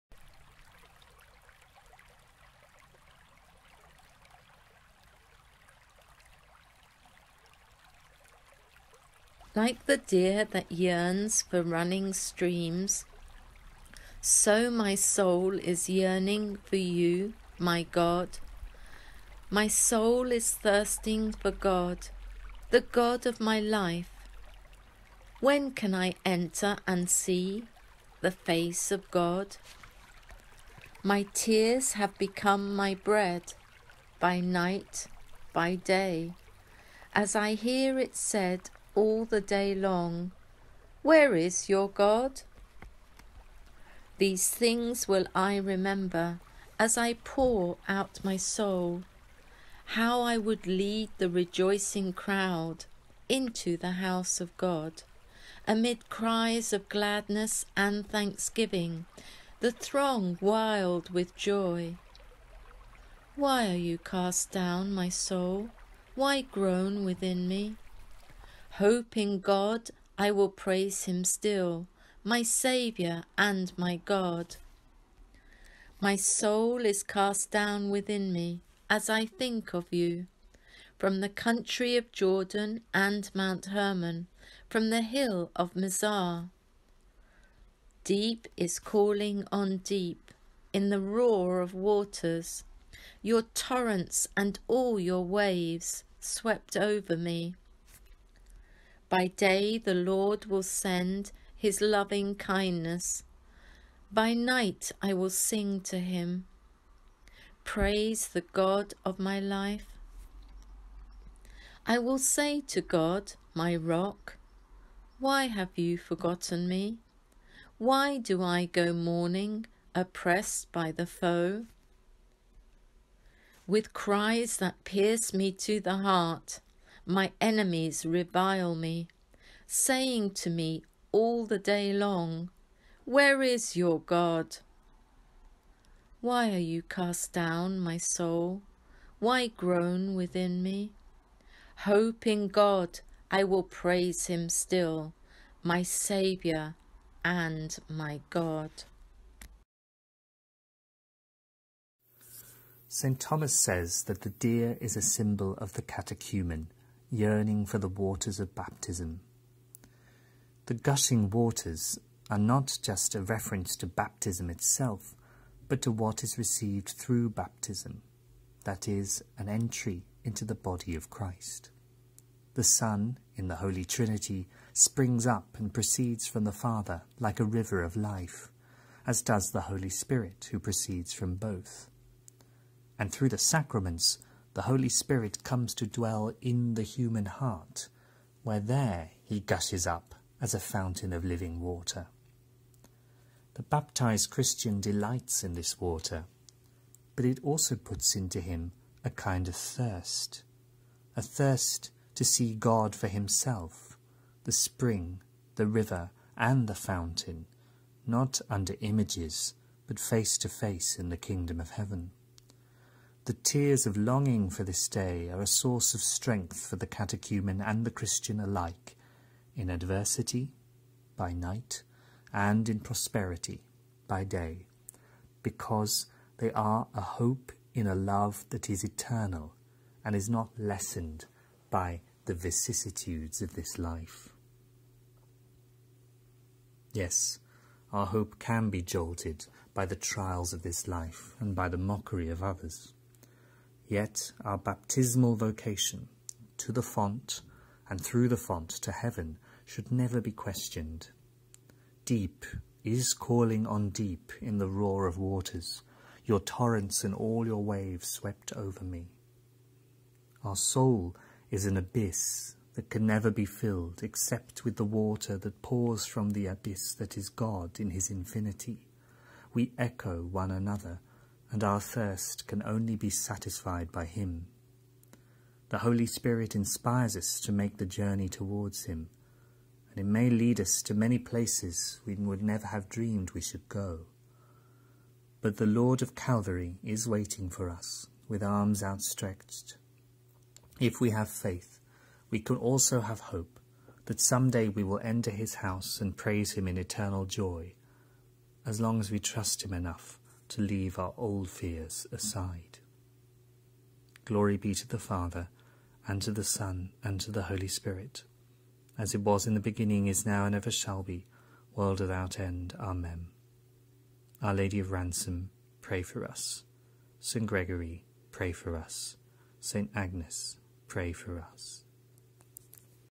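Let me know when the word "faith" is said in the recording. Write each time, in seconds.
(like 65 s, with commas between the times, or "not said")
291 s.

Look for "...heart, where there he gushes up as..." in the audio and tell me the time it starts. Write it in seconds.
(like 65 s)
187 s.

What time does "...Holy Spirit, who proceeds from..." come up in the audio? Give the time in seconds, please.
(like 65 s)
179 s.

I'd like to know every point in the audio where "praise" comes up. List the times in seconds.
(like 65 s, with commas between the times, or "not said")
70 s, 107 s, 143 s, 296 s.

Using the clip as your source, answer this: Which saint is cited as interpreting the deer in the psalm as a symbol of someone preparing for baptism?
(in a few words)
St. Thomas.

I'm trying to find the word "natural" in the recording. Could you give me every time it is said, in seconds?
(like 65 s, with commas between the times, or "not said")
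not said.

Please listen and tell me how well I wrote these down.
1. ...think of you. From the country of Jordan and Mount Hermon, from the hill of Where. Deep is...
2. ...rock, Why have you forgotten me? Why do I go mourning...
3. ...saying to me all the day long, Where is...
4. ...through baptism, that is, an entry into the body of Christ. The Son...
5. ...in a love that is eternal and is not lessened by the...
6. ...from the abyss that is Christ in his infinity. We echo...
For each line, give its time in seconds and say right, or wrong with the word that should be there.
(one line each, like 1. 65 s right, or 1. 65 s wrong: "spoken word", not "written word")
1. 79 s wrong: "Mizar", not "Where"
2. 113 s right
3. 129 s right
4. 166 s right
5. 227 s right
6. 266 s wrong: "God", not "Christ".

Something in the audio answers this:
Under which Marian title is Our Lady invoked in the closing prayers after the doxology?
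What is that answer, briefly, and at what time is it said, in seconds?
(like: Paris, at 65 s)
Our Lady of Ransom, at 314 s.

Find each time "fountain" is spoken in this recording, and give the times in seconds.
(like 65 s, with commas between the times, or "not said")
190 s, 206 s.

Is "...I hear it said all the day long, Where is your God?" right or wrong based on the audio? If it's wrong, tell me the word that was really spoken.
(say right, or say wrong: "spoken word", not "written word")
right.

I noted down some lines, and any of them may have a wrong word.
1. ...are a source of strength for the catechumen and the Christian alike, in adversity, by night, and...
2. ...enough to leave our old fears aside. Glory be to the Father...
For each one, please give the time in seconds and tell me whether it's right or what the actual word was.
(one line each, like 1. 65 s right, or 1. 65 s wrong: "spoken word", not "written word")
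1. 215 s right
2. 299 s right.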